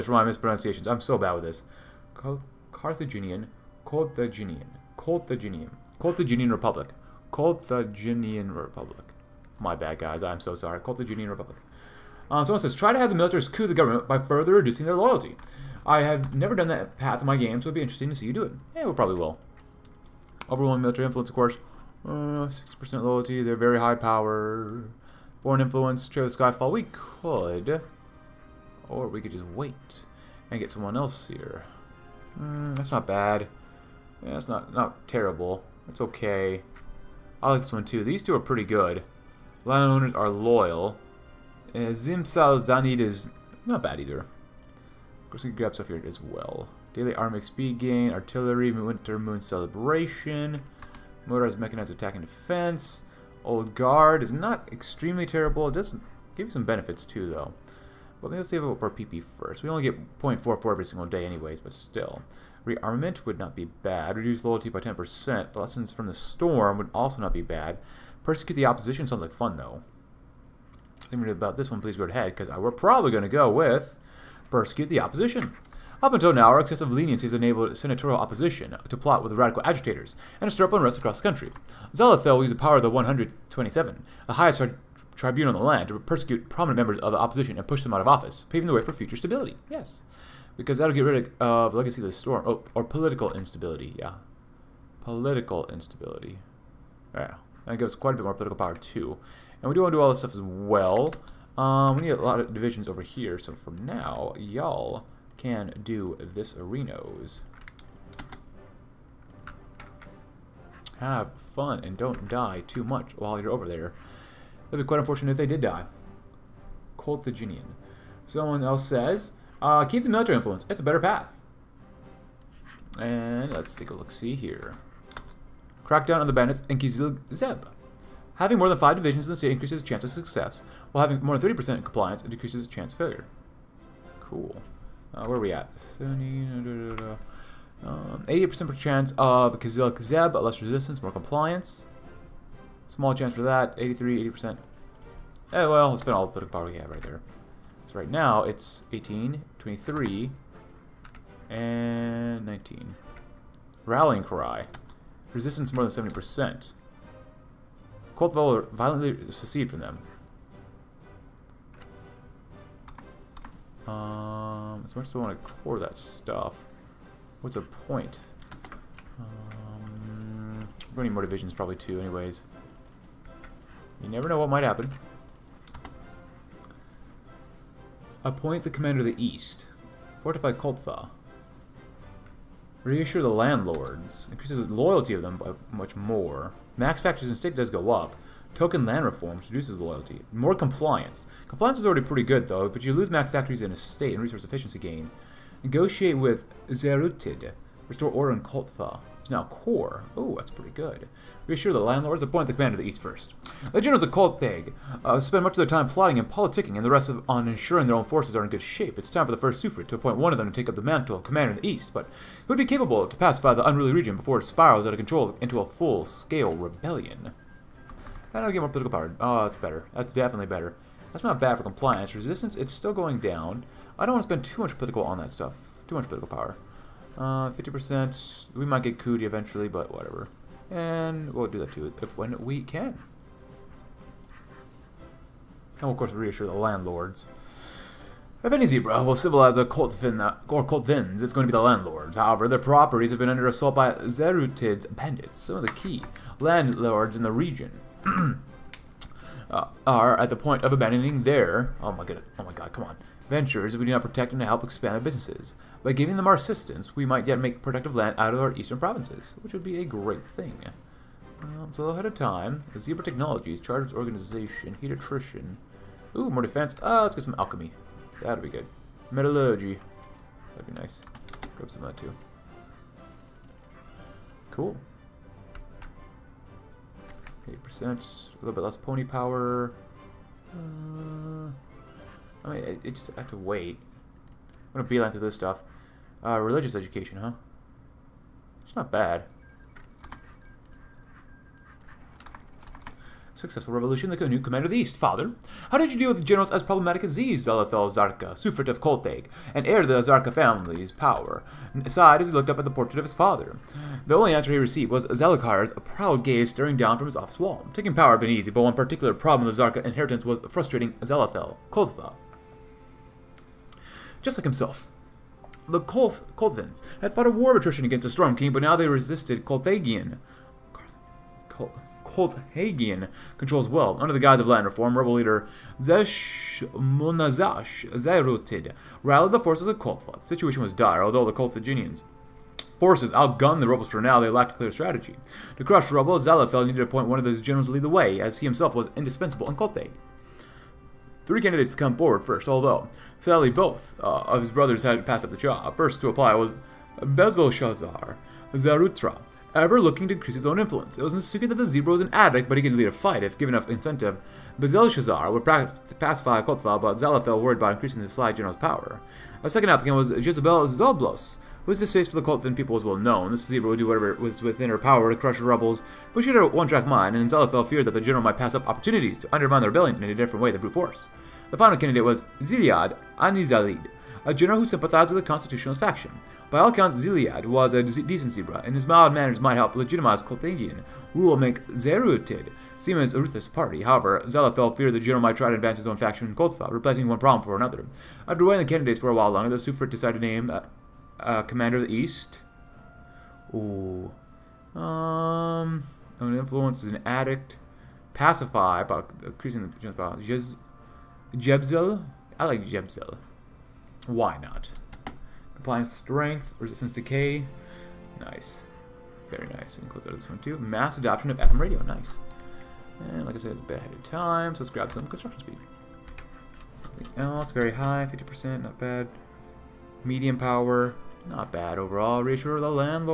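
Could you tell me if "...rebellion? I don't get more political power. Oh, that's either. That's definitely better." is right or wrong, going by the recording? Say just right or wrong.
wrong.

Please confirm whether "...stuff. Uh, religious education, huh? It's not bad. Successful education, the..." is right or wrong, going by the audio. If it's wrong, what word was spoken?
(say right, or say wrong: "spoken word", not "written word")
wrong: "revolution", not "education".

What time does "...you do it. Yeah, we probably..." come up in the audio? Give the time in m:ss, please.
0:18.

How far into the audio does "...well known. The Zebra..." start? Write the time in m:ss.
6:02.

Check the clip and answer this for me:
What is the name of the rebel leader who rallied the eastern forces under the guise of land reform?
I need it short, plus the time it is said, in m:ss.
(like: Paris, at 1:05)
Zesh Munazash Zairutid, at 5:25.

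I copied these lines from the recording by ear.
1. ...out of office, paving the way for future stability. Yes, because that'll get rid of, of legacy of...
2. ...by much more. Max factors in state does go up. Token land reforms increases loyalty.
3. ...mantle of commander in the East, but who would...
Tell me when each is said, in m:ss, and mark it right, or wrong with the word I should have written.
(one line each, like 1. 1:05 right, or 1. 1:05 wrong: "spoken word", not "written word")
1. 1:27 right
2. 3:05 wrong: "reduces", not "increases"
3. 3:30 right.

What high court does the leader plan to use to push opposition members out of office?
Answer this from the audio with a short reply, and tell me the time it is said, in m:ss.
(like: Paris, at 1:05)
the 127, at 1:22.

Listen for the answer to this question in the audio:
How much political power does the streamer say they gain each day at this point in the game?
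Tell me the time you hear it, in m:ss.
1:00.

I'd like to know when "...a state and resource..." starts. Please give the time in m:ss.
3:13.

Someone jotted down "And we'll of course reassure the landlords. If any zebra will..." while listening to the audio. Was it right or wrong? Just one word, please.
right.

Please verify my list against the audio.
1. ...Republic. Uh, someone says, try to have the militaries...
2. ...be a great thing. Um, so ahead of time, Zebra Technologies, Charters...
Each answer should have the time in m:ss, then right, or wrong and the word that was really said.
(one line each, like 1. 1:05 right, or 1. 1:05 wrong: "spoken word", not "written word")
1. 0:11 right
2. 4:19 right.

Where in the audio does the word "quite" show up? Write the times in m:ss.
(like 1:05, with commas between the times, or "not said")
1:37, 1:54.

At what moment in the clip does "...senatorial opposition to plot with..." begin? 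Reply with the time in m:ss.
1:17.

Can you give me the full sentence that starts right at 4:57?
Zalathel Zarka, Sufret of Kolteg, and heir to the Zarka family's power.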